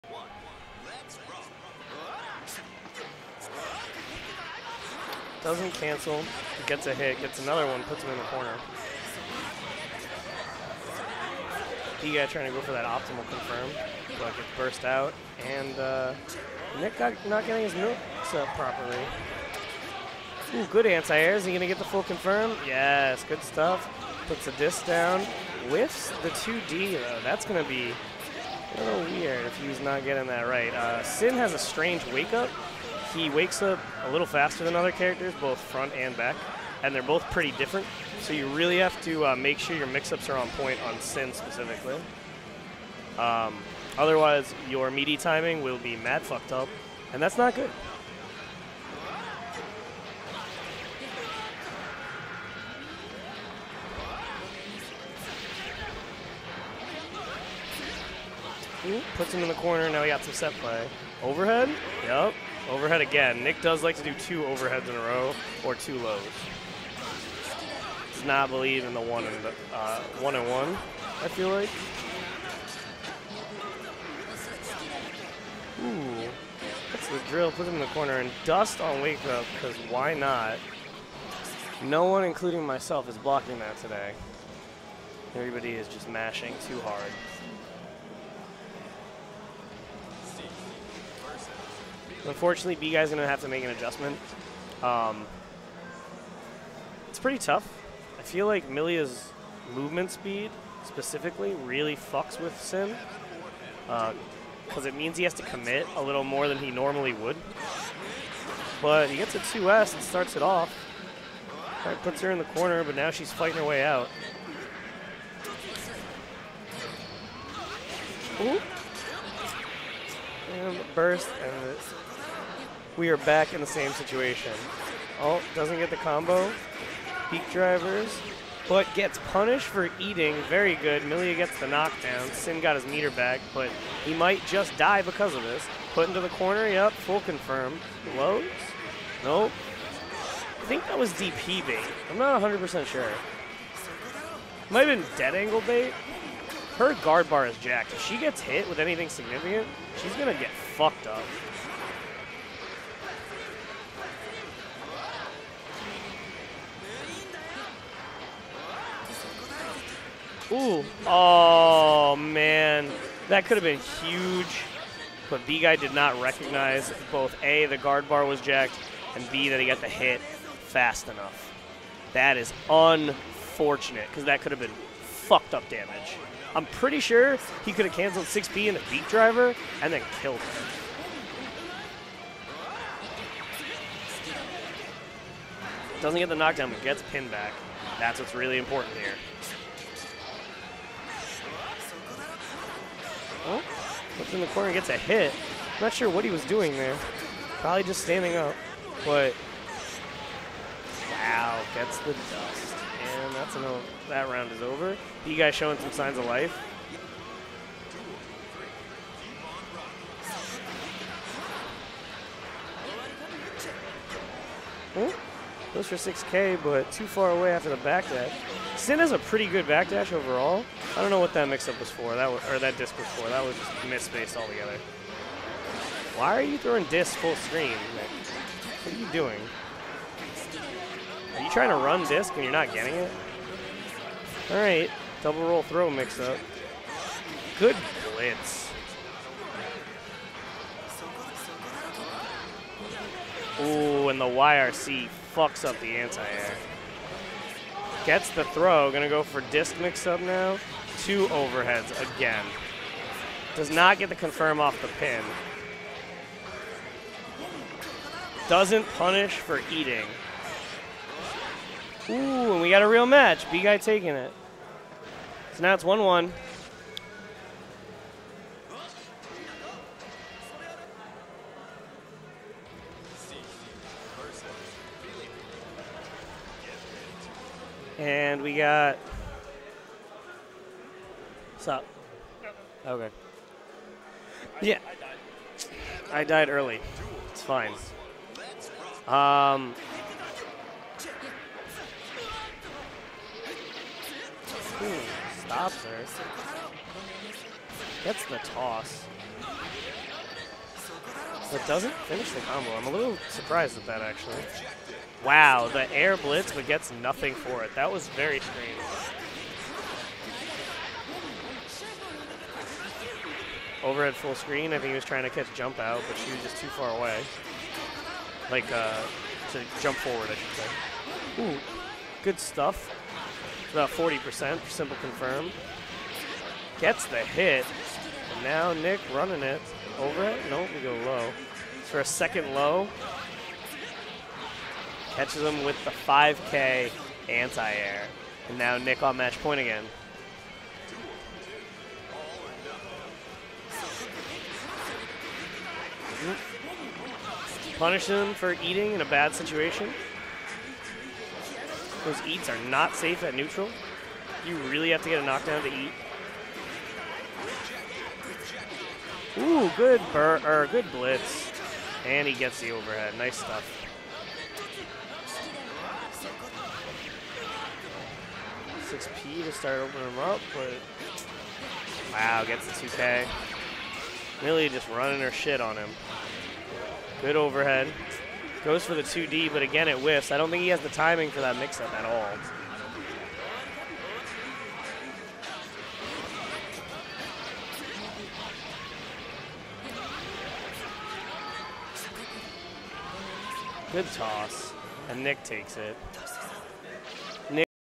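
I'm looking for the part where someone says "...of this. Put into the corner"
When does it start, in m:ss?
2:15.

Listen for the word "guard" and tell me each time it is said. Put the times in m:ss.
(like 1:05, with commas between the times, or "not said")
2:27, 2:47.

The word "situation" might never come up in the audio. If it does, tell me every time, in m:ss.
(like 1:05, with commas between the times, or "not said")
2:03, 5:49.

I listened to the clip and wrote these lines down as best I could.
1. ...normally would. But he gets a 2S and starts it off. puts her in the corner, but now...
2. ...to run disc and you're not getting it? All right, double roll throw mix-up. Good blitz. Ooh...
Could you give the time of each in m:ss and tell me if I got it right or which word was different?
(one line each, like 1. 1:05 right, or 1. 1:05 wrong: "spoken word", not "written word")
1. 1:46 right
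2. 3:51 right.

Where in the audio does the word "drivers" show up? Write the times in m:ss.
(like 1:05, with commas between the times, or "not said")
2:07, 2:59.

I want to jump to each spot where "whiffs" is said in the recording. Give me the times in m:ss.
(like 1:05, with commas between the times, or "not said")
0:25, 6:19.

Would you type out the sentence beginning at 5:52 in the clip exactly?
Those eats are not safe at neutral.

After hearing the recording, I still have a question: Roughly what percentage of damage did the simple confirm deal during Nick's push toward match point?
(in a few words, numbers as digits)
40%.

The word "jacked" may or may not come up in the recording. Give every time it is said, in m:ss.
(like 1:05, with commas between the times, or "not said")
2:27, 2:48.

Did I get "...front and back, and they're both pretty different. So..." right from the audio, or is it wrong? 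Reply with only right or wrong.
right.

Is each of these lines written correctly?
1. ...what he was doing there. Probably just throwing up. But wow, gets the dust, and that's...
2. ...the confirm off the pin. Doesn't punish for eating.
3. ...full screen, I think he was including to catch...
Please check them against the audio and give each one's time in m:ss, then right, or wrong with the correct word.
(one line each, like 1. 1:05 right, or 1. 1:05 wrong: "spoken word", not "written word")
1. 3:16 wrong: "standing", not "throwing"
2. 4:14 right
3. 5:14 wrong: "trying", not "including".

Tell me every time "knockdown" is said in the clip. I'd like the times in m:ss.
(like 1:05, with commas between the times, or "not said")
2:11, 3:06, 5:55.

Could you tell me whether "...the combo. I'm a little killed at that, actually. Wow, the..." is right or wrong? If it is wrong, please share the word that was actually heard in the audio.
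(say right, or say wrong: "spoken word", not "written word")
wrong: "surprised", not "killed".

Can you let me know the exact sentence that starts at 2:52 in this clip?
That is unfortunate because that could have been fucked up damage.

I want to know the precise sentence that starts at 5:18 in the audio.
Like, uh, to jump forward, I should say.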